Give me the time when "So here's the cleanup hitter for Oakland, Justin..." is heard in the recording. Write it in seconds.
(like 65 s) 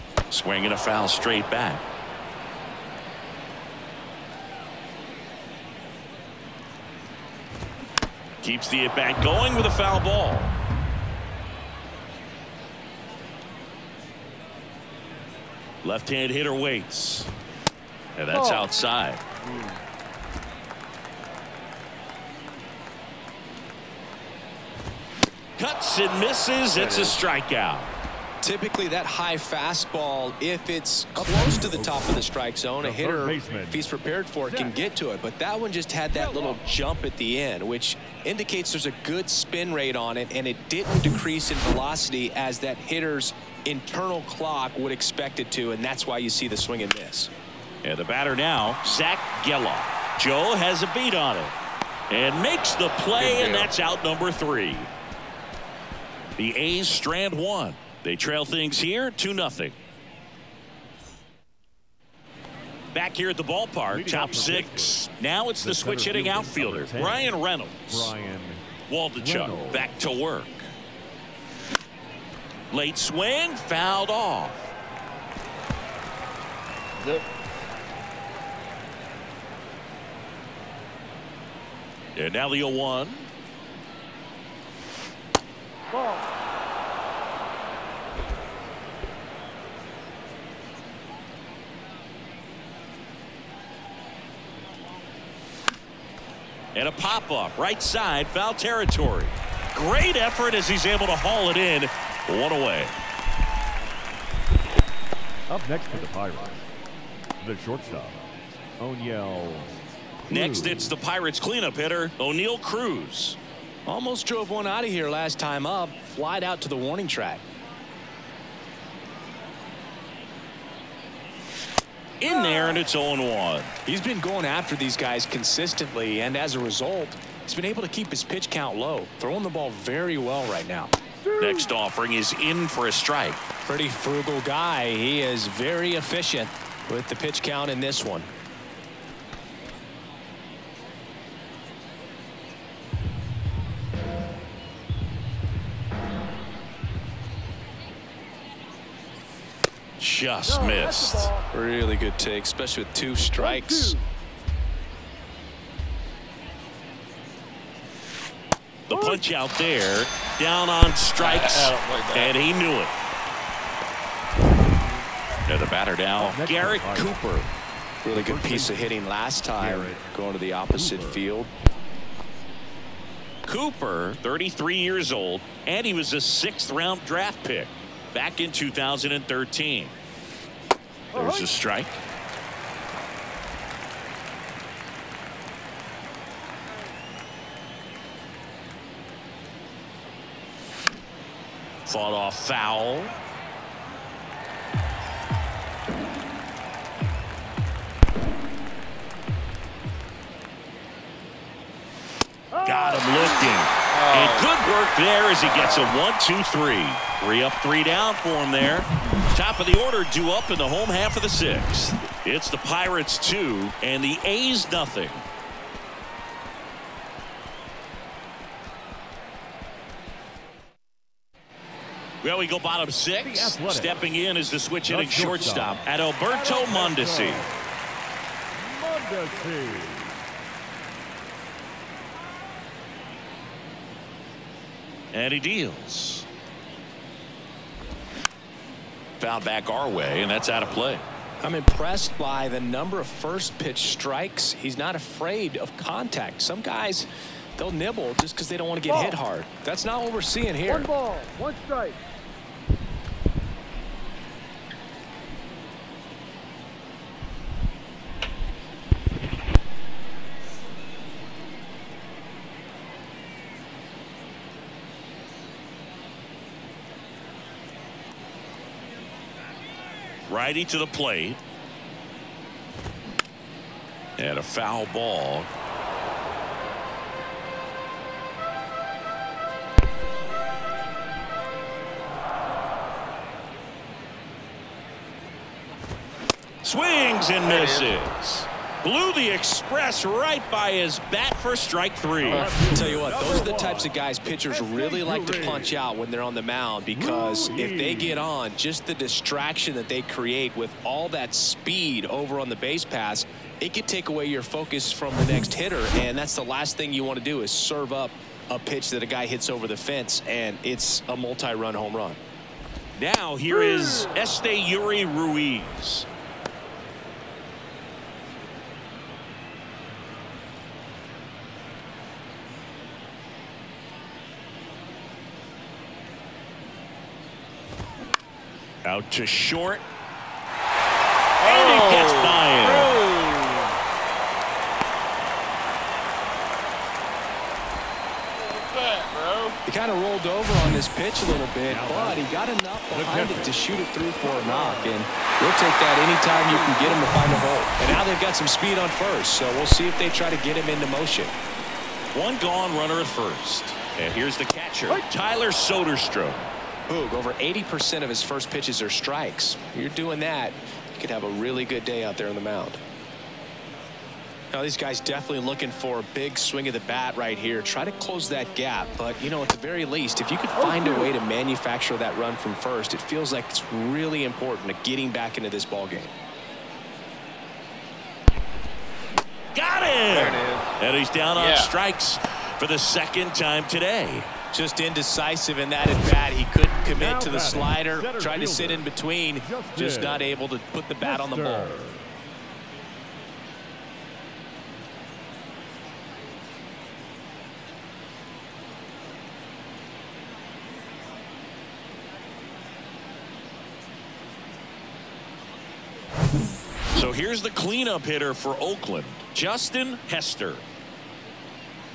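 406 s.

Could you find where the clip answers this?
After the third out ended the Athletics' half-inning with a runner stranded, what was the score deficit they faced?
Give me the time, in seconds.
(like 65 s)
59 s.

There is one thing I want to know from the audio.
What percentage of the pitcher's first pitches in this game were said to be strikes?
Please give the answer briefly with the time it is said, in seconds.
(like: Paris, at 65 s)
80%, at 357 s.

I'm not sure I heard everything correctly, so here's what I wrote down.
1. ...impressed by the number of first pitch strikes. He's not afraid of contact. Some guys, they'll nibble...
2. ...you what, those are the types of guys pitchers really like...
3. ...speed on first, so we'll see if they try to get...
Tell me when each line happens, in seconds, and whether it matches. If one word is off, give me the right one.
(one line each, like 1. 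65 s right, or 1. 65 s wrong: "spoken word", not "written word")
1. 241 s right
2. 292 s right
3. 348 s right.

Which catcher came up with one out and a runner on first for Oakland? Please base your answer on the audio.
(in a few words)
Tyler Soderstrom.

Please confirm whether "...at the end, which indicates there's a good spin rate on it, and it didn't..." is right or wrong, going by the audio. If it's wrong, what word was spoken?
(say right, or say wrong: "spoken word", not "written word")
right.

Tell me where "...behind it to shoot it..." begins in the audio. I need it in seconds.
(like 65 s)
342 s.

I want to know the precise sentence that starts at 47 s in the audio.
And the batter now, Zack Gelof.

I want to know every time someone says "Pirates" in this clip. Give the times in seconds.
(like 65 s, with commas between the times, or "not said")
106 s, 110 s, 212 s.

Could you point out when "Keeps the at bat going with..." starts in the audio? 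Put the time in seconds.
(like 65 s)
8 s.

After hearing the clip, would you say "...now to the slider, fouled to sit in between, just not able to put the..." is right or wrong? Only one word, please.
wrong.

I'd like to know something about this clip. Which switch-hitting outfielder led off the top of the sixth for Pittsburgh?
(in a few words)
Bryan Reynolds.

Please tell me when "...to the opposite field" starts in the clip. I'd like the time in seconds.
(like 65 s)
170 s.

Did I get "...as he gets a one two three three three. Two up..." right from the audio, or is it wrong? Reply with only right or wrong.
wrong.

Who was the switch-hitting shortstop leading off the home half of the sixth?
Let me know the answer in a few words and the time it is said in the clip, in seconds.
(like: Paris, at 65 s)
Adalberto Mondesi, at 225 s.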